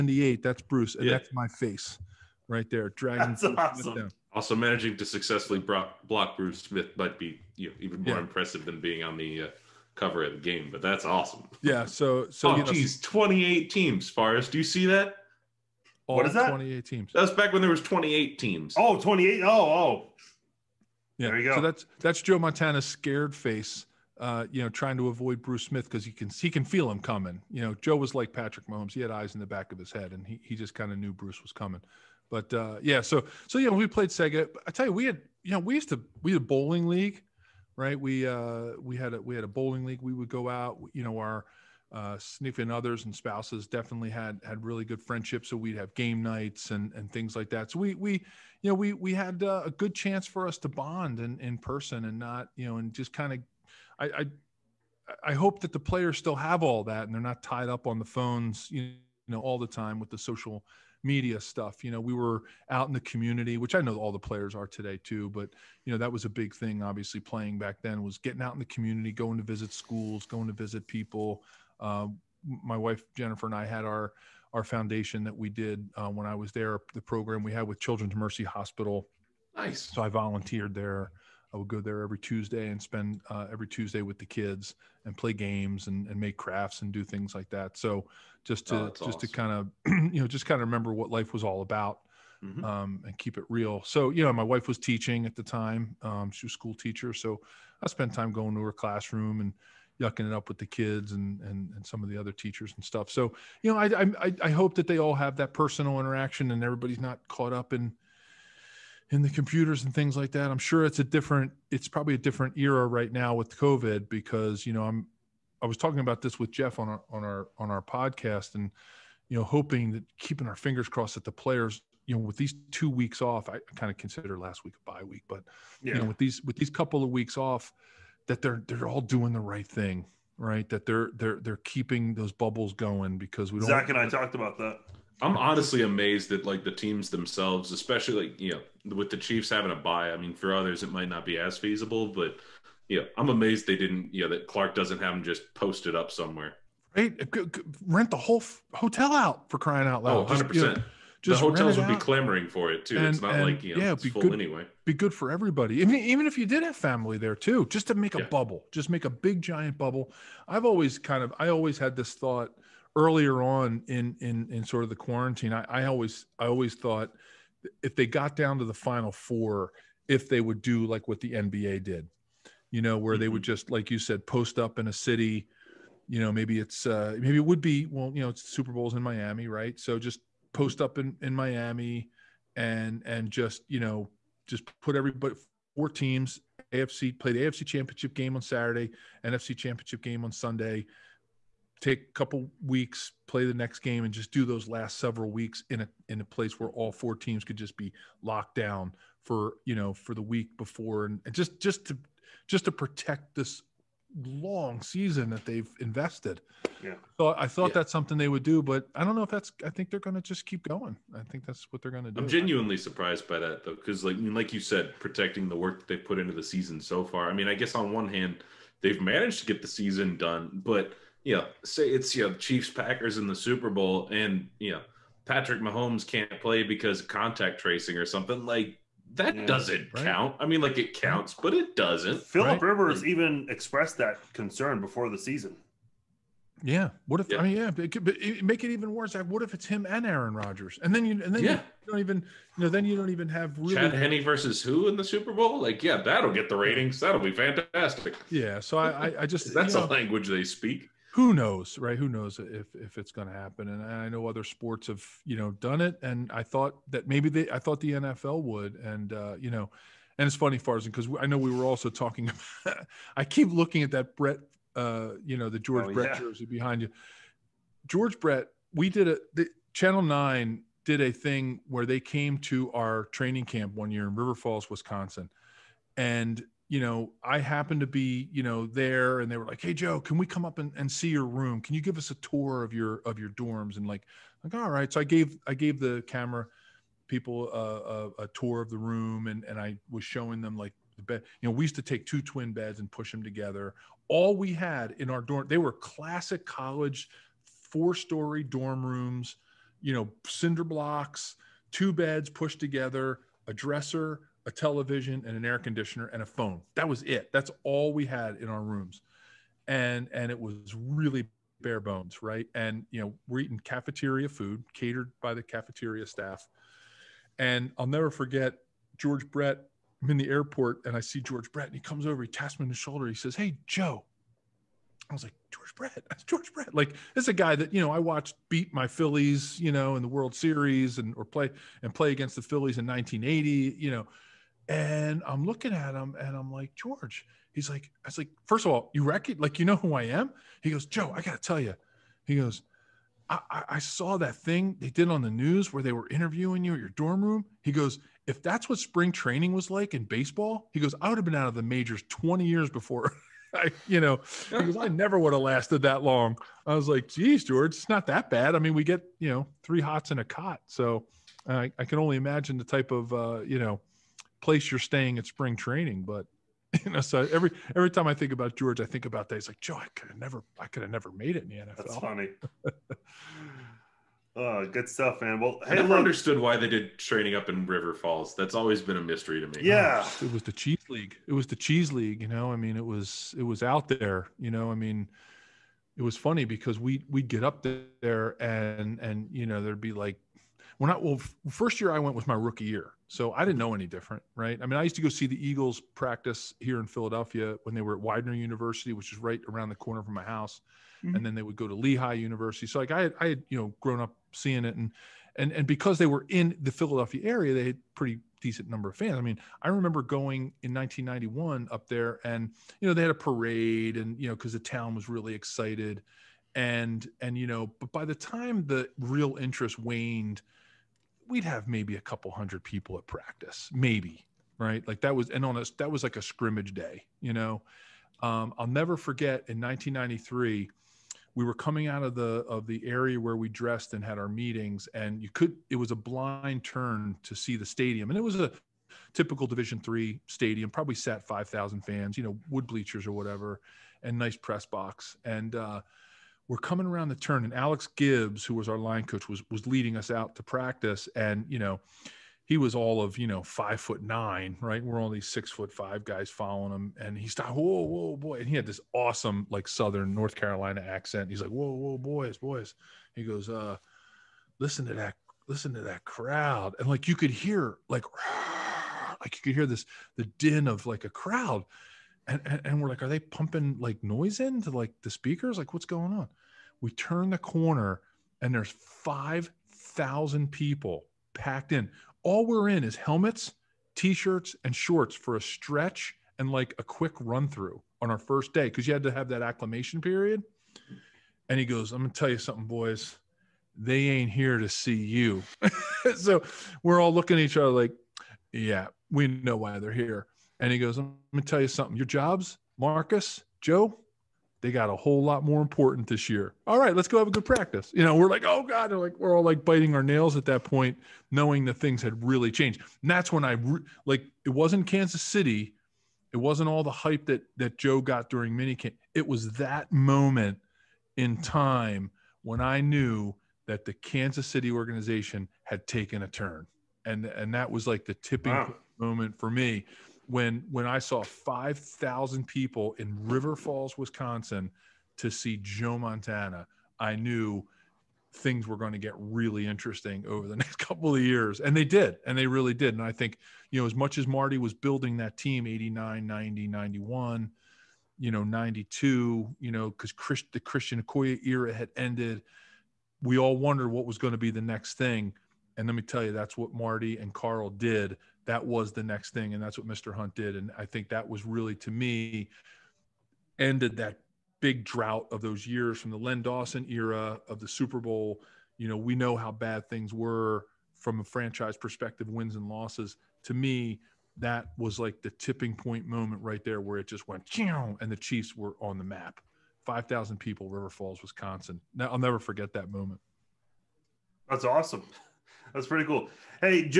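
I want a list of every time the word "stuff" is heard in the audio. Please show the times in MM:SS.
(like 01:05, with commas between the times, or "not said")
01:01, 01:42, 06:14.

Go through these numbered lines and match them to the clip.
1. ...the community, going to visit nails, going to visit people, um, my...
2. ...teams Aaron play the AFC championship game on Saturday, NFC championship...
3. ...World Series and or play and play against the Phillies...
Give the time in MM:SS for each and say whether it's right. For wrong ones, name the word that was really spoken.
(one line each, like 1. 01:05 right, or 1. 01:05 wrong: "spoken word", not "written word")
1. 01:08 wrong: "schools", not "nails"
2. 03:05 wrong: "AFC", not "Aaron"
3. 05:30 right.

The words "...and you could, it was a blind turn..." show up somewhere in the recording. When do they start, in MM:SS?
07:14.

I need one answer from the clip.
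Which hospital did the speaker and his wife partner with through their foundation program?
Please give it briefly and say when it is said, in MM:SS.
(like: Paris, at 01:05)
Children's Mercy Hospital, at 01:17.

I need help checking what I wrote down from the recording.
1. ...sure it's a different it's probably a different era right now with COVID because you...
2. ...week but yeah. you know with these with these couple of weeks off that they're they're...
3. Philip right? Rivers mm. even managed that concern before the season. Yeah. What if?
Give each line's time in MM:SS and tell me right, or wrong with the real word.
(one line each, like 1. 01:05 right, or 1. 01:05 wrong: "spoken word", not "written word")
1. 01:50 right
2. 02:05 right
3. 03:52 wrong: "expressed", not "managed".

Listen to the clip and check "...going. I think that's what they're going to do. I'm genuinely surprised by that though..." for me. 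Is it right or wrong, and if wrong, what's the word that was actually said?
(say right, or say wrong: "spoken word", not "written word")
right.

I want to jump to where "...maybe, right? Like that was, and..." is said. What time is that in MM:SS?
07:03.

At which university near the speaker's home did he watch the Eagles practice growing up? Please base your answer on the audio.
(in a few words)
Widener University.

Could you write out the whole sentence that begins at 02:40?
I've always kind of I always had this thought earlier on in in in sort of the quarantine.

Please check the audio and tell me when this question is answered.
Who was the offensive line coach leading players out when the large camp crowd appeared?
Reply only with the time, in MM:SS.
07:27.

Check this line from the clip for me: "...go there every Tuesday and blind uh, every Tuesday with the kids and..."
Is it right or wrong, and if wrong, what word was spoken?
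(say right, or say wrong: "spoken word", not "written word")
wrong: "spend", not "blind".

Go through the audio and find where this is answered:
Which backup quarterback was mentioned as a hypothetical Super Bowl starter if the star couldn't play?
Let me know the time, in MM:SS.
04:03.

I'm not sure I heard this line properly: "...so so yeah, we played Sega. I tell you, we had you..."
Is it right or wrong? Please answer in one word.
right.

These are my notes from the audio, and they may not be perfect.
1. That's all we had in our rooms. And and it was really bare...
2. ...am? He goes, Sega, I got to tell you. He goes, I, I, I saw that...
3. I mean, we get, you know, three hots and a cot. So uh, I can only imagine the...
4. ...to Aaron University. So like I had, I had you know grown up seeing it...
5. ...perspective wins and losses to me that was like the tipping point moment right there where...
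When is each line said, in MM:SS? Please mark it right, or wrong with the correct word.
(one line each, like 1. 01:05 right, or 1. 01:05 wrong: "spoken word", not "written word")
1. 05:07 right
2. 05:40 wrong: "Joe", not "Sega"
3. 05:58 right
4. 06:41 wrong: "Lehigh", not "Aaron"
5. 09:31 right.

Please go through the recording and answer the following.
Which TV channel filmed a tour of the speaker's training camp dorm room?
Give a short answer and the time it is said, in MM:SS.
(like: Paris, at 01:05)
Channel Nine, at 04:29.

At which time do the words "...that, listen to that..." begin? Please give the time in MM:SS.
07:44.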